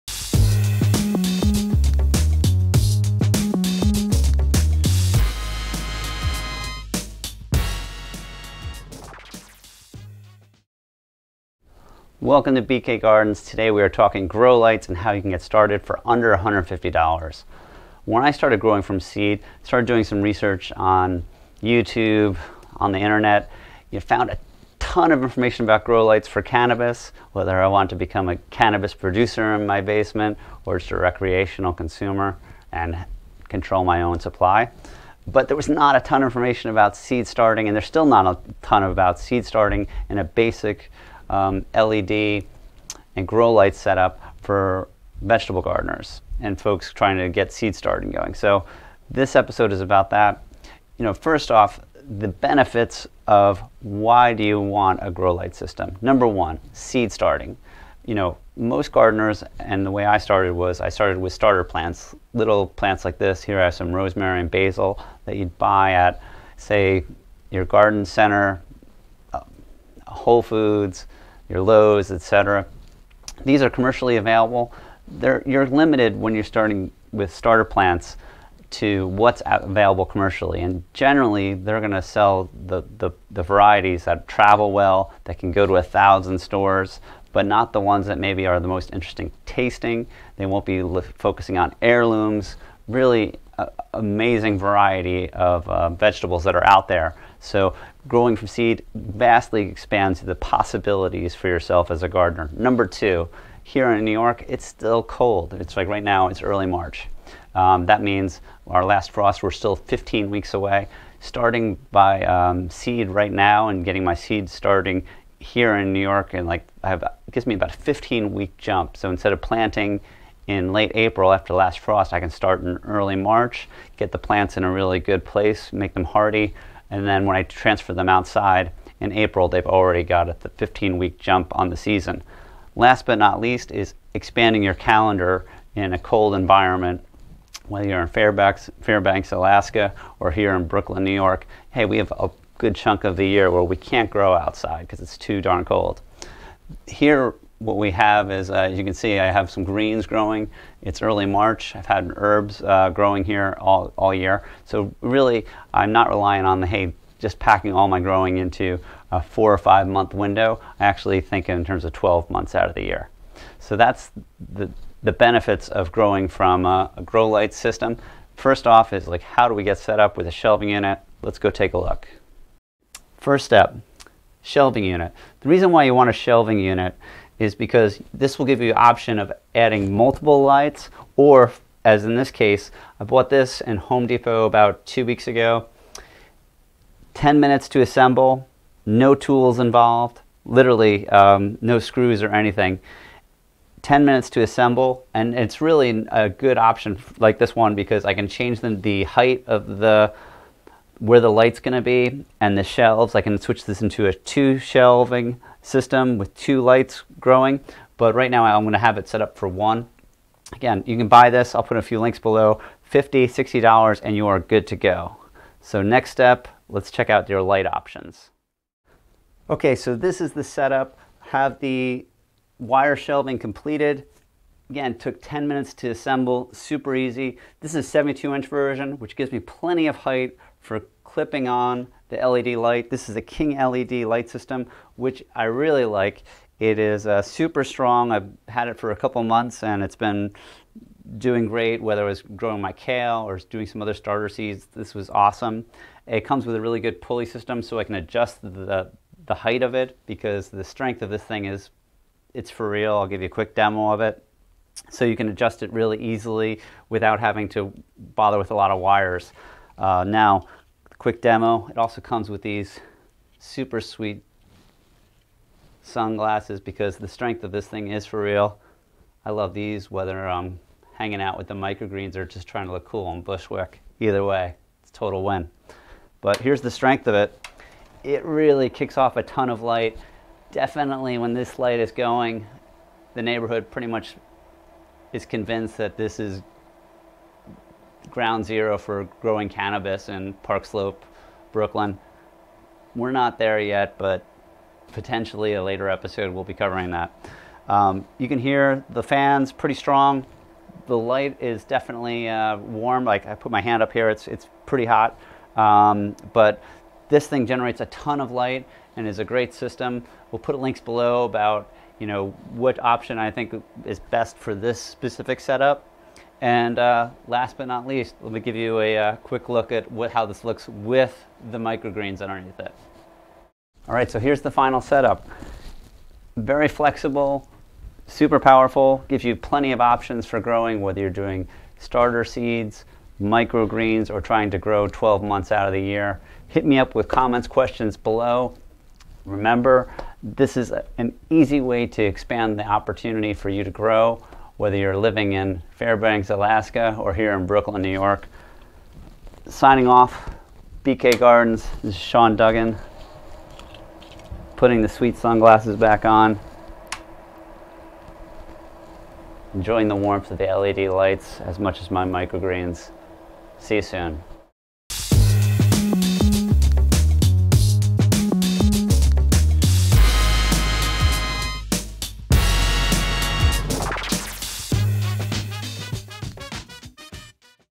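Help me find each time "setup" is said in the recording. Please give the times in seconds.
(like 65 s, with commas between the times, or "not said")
43 s, 220 s, 315 s, 324 s.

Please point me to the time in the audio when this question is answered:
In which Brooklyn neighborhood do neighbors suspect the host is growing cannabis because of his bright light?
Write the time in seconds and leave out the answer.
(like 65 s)
290 s.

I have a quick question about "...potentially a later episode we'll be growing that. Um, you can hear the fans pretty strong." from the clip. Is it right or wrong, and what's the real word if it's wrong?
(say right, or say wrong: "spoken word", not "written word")
wrong: "covering", not "growing".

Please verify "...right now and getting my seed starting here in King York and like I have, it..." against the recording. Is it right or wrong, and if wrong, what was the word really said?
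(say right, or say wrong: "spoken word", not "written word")
wrong: "New", not "King".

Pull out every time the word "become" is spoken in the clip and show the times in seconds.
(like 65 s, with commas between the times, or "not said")
27 s.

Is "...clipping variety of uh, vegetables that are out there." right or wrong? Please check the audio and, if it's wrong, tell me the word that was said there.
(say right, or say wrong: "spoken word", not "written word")
wrong: "amazing", not "clipping".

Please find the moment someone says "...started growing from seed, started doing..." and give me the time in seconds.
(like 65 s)
18 s.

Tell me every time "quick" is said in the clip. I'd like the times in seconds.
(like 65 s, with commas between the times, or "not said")
253 s, 260 s, 319 s.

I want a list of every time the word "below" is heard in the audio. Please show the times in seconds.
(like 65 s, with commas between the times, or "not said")
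212 s, 310 s, 337 s.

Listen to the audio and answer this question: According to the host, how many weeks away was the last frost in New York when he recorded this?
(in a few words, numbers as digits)
15.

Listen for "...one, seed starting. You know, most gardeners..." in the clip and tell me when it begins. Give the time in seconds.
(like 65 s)
56 s.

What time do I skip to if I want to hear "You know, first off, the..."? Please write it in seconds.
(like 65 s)
50 s.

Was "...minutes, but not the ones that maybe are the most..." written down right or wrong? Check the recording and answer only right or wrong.
wrong.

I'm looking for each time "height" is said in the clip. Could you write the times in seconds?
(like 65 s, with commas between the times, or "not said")
199 s, 229 s, 249 s.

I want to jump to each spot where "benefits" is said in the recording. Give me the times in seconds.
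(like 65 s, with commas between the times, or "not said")
52 s, 165 s.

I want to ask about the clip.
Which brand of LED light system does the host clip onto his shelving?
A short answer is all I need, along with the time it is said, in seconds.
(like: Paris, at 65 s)
King LED, at 233 s.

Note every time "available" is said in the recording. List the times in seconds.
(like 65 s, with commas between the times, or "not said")
74 s, 79 s.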